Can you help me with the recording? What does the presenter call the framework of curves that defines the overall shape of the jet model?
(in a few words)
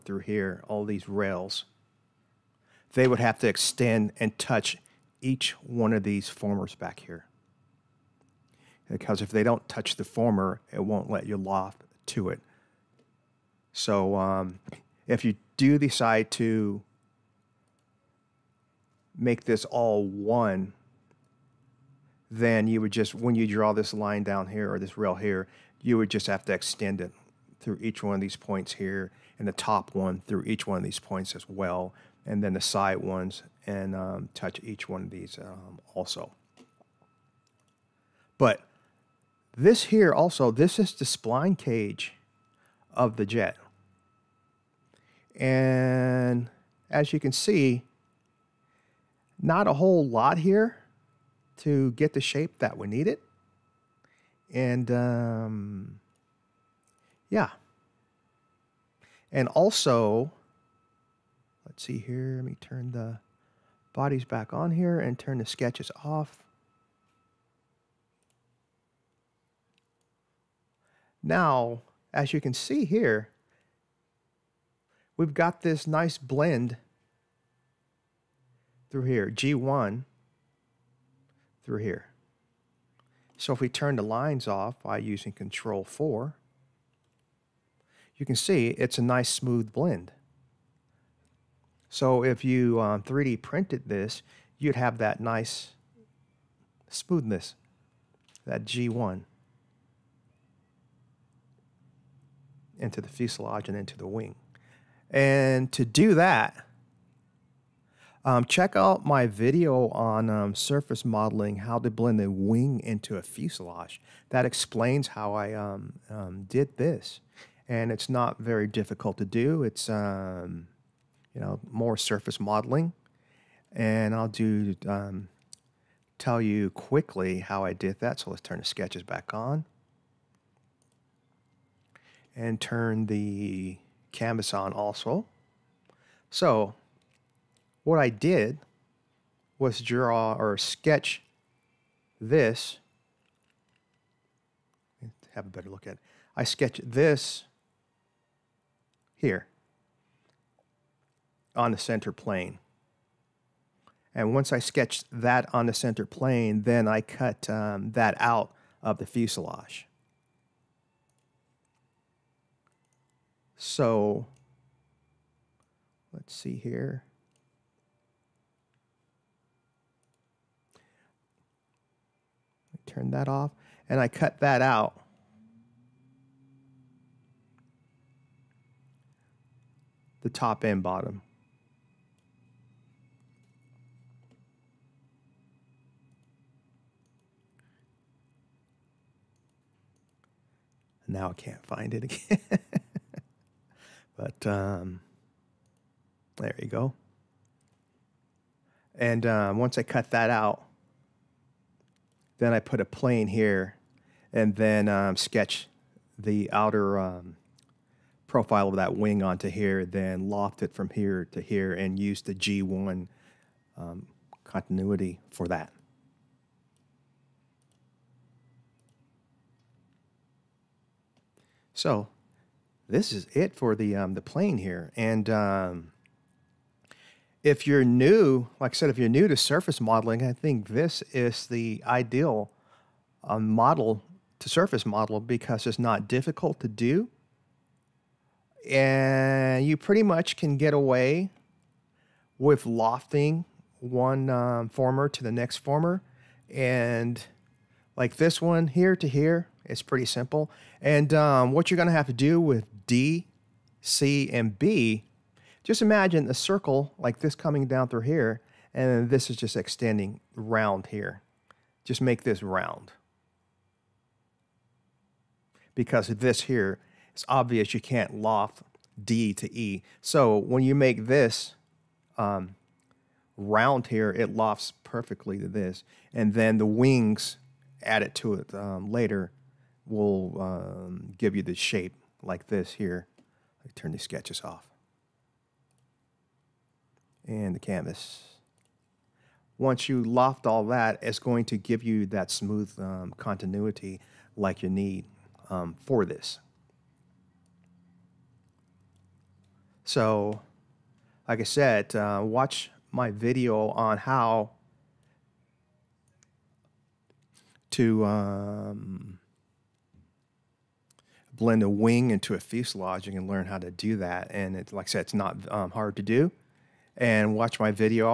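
Spline cage.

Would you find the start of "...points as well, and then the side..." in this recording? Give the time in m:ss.
0:30.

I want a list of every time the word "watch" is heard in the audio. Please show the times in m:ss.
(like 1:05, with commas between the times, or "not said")
5:02, 5:17.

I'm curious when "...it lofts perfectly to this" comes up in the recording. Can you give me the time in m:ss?
4:34.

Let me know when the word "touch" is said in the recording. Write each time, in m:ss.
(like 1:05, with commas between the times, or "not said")
0:04, 0:09, 0:34.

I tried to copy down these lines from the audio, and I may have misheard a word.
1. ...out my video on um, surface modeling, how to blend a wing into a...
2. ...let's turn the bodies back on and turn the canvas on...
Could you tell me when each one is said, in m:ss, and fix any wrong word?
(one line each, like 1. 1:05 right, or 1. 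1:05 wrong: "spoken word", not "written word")
1. 1:48 right
2. 2:08 wrong: "sketches", not "bodies".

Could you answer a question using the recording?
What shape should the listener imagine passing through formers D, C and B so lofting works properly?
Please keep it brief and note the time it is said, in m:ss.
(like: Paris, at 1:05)
A circle, at 4:16.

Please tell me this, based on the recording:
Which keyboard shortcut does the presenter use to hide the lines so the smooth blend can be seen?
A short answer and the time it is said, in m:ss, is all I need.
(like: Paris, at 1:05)
Control 4, at 1:25.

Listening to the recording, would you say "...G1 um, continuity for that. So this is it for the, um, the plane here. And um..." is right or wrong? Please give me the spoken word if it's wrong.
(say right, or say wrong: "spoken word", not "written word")
right.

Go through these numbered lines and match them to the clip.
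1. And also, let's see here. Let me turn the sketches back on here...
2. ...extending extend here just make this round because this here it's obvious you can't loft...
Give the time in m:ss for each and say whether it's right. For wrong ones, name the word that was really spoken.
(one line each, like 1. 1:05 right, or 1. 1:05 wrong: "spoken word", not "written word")
1. 0:59 wrong: "bodies", not "sketches"
2. 4:19 wrong: "round", not "extend".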